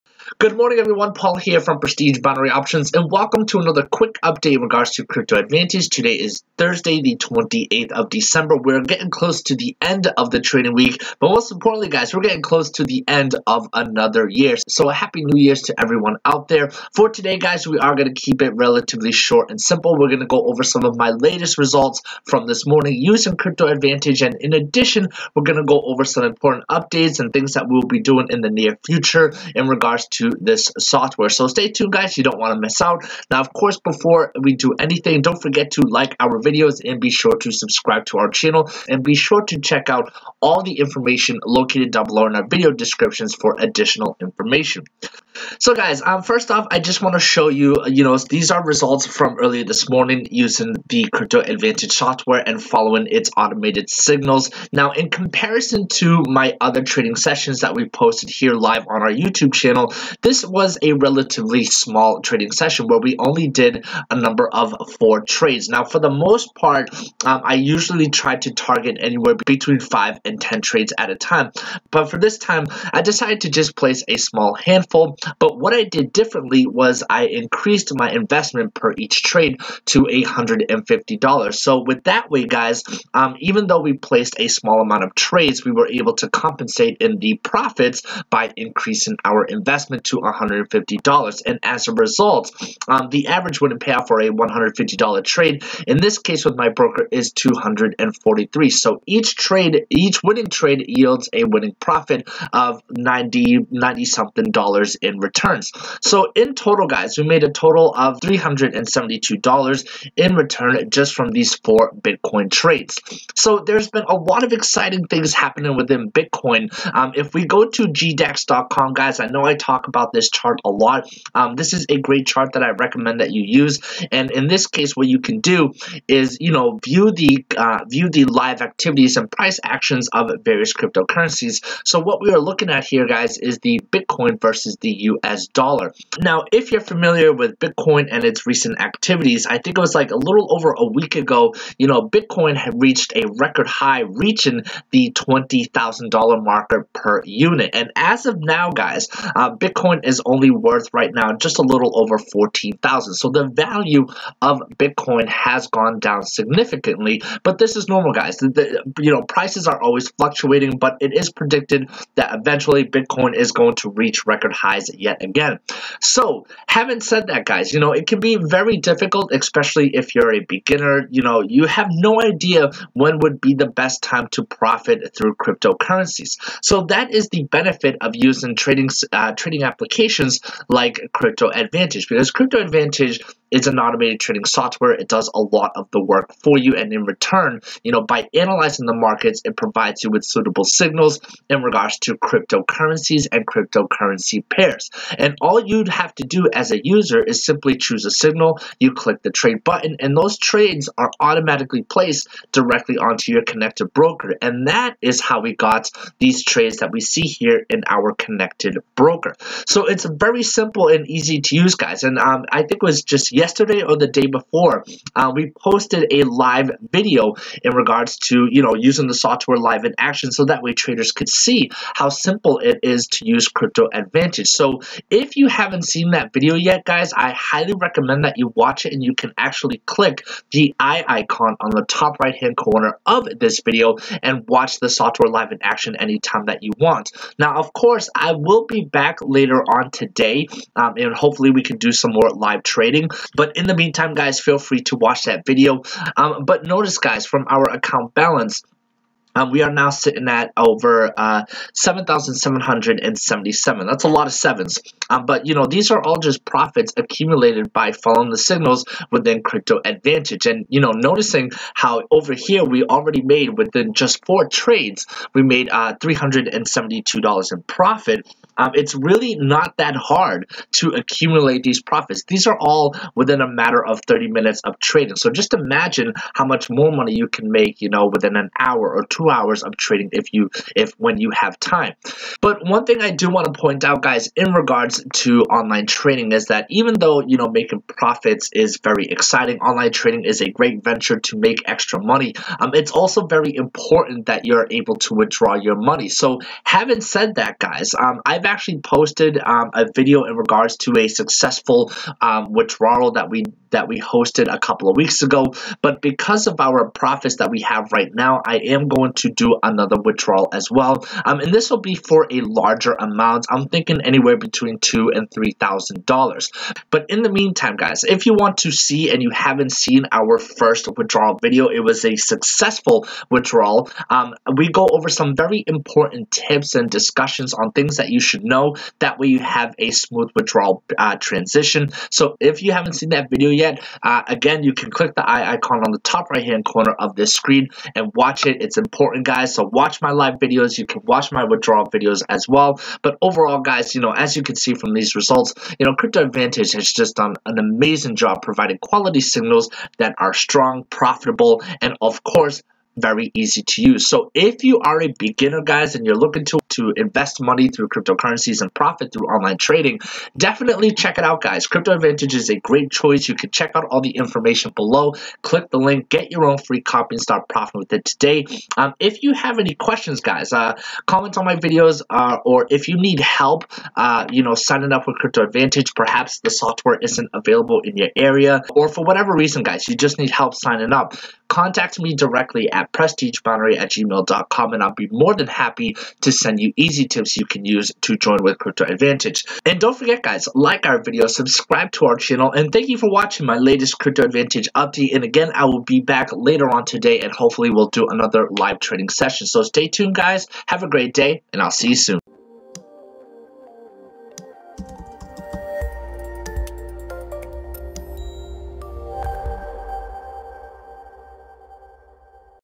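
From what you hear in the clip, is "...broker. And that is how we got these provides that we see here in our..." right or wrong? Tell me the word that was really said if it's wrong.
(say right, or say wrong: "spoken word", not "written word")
wrong: "trades", not "provides".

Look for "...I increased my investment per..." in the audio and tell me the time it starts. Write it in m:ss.
1:17.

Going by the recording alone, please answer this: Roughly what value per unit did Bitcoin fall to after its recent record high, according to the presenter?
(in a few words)
a little over 14,000.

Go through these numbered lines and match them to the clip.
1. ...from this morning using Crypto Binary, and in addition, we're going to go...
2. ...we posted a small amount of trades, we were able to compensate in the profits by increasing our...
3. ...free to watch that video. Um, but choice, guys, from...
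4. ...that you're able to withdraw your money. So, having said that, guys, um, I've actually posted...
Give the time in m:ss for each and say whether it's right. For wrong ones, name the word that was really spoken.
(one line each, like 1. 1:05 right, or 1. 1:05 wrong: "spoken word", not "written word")
1. 0:22 wrong: "Advantage", not "Binary"
2. 1:23 wrong: "placed", not "posted"
3. 4:04 wrong: "notice", not "choice"
4. 4:54 right.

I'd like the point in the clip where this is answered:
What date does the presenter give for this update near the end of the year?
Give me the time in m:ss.
0:06.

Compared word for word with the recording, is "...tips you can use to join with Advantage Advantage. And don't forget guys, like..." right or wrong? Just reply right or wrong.
wrong.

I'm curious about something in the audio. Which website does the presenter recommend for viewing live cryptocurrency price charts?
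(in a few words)
gdax.com.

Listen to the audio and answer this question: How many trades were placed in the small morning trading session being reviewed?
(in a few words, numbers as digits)
4.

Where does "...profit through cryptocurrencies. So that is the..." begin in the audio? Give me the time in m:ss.
2:54.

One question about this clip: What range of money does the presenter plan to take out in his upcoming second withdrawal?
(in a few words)
$2,000 to $3,000.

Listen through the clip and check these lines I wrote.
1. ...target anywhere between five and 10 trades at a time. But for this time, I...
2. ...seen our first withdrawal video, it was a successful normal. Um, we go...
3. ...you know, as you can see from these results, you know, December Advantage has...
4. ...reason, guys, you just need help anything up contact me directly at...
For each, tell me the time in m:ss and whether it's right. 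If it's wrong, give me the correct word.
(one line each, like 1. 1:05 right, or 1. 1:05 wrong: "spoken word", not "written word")
1. 1:08 right
2. 5:19 wrong: "withdrawal", not "normal"
3. 5:43 wrong: "Crypto", not "December"
4. 6:19 wrong: "signing", not "anything".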